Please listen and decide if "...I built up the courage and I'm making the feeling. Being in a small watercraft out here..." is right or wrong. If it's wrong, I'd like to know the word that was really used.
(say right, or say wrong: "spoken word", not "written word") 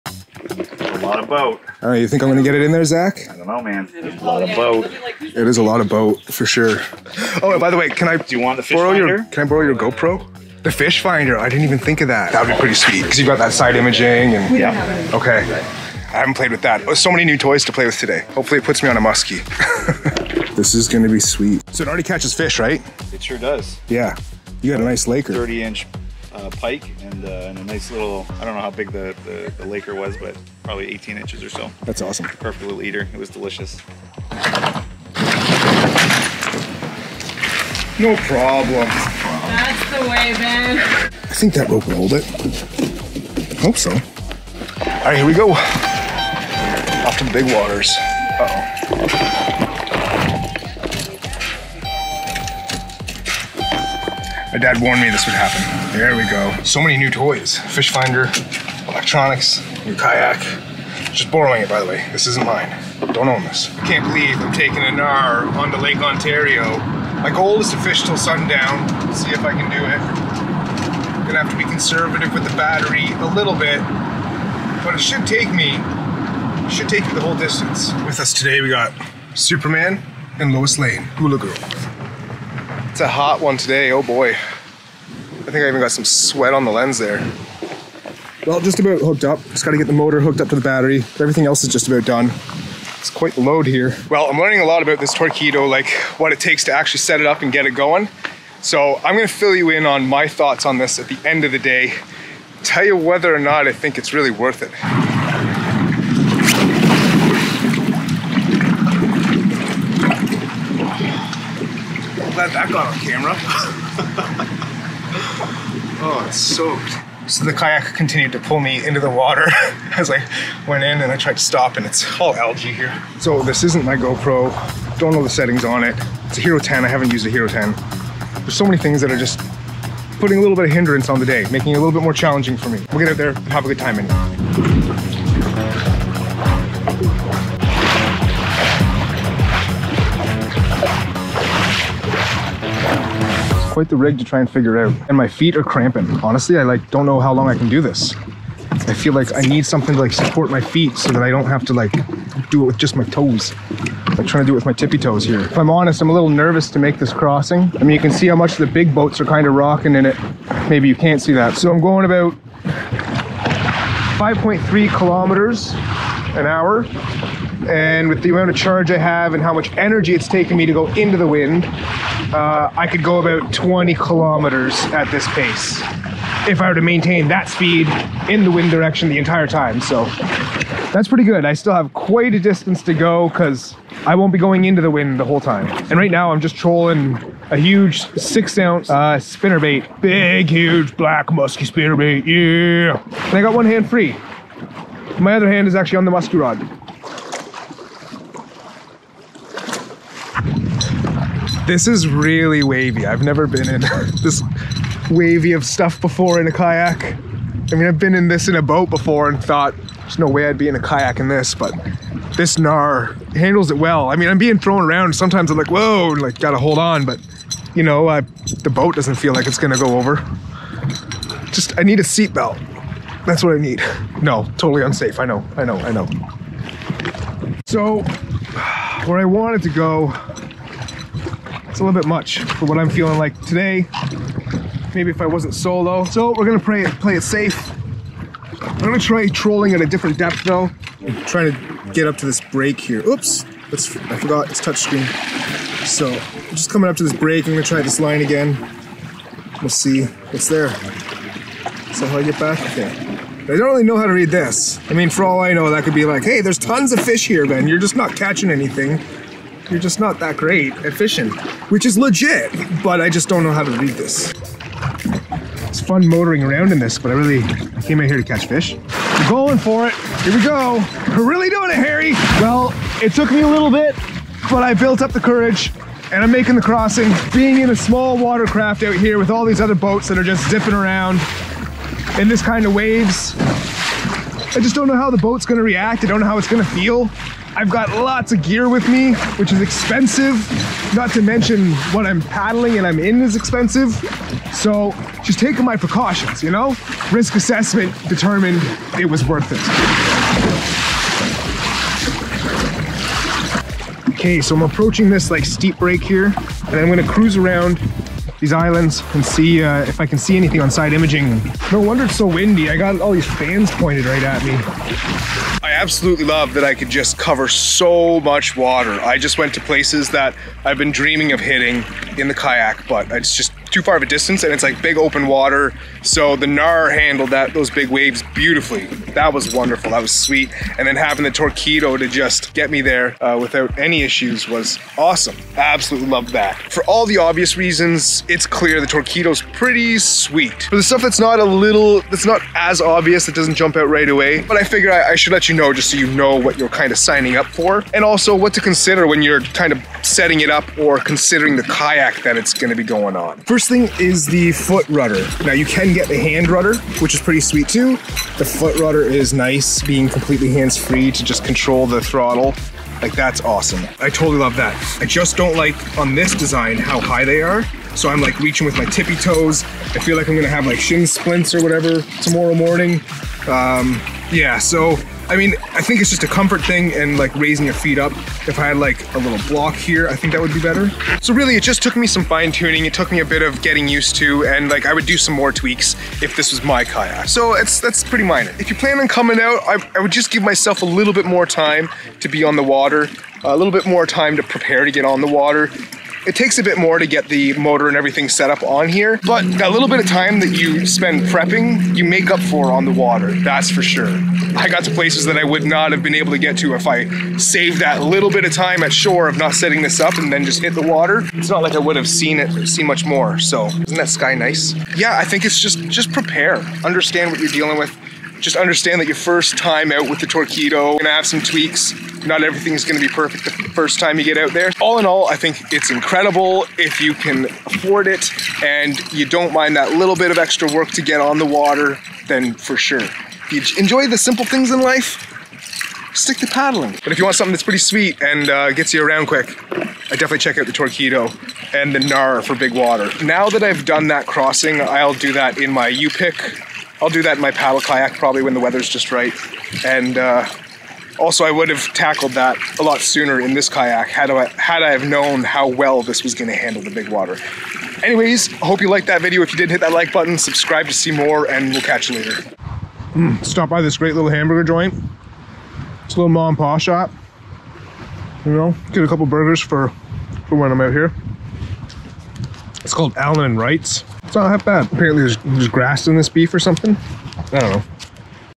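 wrong: "crossing", not "feeling".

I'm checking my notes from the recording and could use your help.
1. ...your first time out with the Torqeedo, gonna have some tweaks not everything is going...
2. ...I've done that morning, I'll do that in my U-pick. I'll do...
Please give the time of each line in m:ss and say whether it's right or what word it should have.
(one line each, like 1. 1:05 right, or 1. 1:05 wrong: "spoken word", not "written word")
1. 6:59 right
2. 7:23 wrong: "crossing", not "morning".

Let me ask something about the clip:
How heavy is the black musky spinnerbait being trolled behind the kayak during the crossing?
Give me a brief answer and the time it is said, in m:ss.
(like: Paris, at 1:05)
6 ounce, at 3:08.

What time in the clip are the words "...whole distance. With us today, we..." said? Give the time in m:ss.
1:17.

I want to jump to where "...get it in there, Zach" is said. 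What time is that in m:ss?
0:02.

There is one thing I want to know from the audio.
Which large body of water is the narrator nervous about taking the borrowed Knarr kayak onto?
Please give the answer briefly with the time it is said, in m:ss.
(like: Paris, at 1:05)
Lake Ontario, at 1:05.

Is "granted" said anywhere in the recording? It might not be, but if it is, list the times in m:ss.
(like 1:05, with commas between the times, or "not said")
not said.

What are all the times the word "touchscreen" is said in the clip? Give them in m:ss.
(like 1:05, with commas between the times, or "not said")
4:04.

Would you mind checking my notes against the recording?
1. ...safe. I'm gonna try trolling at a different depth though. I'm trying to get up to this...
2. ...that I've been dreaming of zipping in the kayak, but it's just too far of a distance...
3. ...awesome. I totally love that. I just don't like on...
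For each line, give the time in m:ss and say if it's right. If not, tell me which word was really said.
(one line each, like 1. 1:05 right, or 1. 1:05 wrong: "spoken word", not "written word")
1. 3:57 right
2. 5:20 wrong: "hitting", not "zipping"
3. 6:03 right.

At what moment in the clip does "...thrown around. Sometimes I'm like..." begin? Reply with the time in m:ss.
3:34.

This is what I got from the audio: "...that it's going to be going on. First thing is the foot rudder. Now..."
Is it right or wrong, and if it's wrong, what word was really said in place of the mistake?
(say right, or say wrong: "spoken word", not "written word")
right.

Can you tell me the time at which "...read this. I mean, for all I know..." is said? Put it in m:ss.
4:14.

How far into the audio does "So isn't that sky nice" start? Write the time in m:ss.
6:53.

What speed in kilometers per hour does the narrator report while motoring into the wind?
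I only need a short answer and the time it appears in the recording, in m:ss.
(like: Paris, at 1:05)
5.3, at 2:44.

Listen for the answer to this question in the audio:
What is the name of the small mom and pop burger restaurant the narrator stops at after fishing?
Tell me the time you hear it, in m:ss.
7:53.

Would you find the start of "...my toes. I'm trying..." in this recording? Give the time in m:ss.
2:32.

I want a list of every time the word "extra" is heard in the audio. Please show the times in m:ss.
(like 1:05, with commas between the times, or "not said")
7:10.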